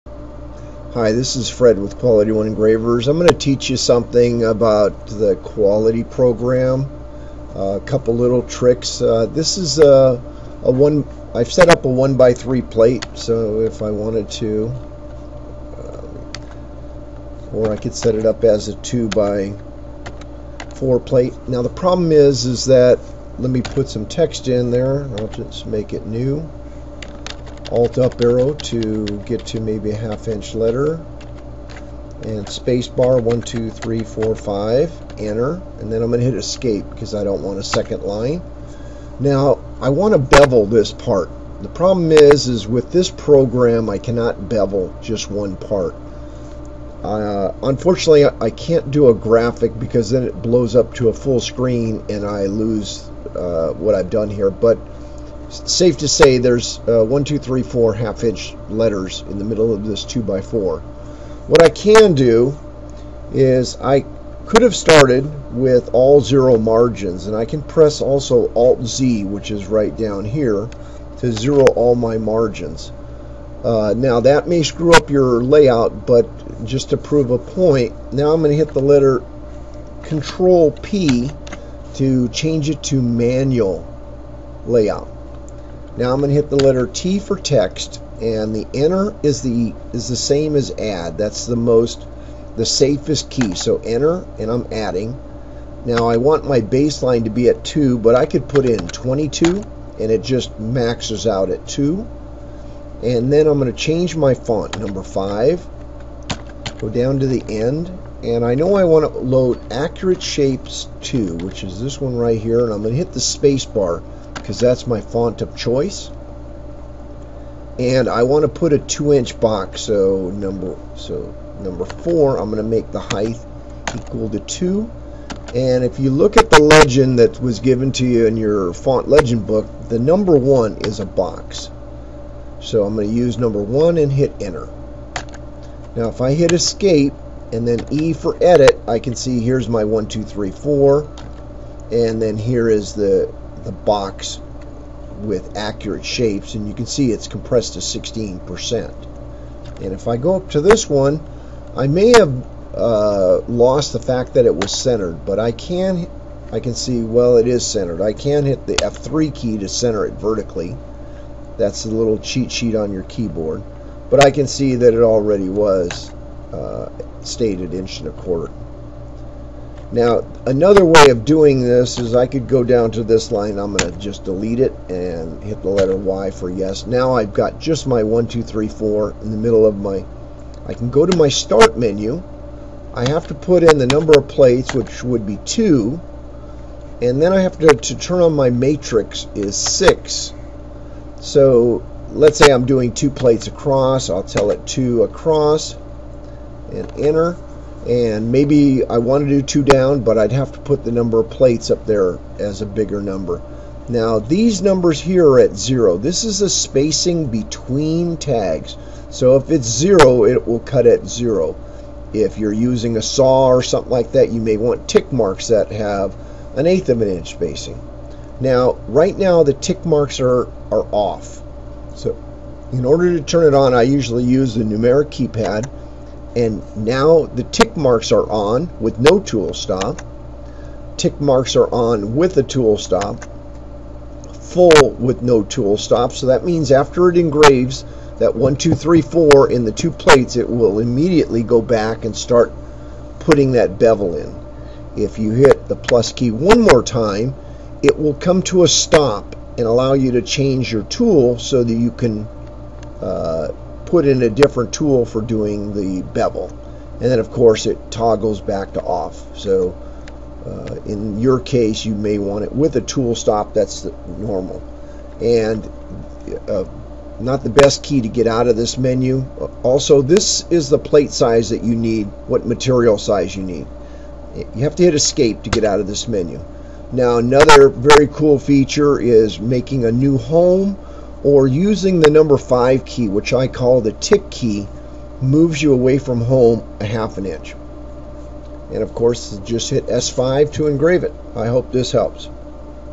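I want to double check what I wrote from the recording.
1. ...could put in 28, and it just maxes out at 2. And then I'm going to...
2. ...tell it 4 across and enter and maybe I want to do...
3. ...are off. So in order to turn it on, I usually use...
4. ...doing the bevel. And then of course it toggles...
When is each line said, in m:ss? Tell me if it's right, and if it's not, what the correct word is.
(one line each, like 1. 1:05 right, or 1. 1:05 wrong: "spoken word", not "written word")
1. 1:38 wrong: "22", not "28"
2. 3:14 wrong: "2", not "4"
3. 3:40 right
4. 4:15 right.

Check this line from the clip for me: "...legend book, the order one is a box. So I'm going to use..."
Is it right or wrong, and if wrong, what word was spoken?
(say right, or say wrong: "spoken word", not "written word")
wrong: "number", not "order".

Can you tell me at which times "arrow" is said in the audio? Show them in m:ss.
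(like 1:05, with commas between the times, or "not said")
0:28.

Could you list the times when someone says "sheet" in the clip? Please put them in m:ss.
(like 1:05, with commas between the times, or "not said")
2:42.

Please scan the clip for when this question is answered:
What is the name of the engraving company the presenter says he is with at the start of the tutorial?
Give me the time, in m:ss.
0:01.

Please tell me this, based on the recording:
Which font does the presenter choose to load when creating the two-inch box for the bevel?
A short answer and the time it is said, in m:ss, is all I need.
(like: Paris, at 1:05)
Accurate Shapes 2, at 1:49.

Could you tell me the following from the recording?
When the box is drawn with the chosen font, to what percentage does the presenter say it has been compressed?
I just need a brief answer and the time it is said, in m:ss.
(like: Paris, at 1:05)
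16%, at 2:27.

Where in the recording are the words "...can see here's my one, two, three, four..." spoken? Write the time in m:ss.
2:18.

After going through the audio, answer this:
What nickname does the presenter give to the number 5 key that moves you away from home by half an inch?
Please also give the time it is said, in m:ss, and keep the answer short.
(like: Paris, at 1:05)
the tick key, at 4:43.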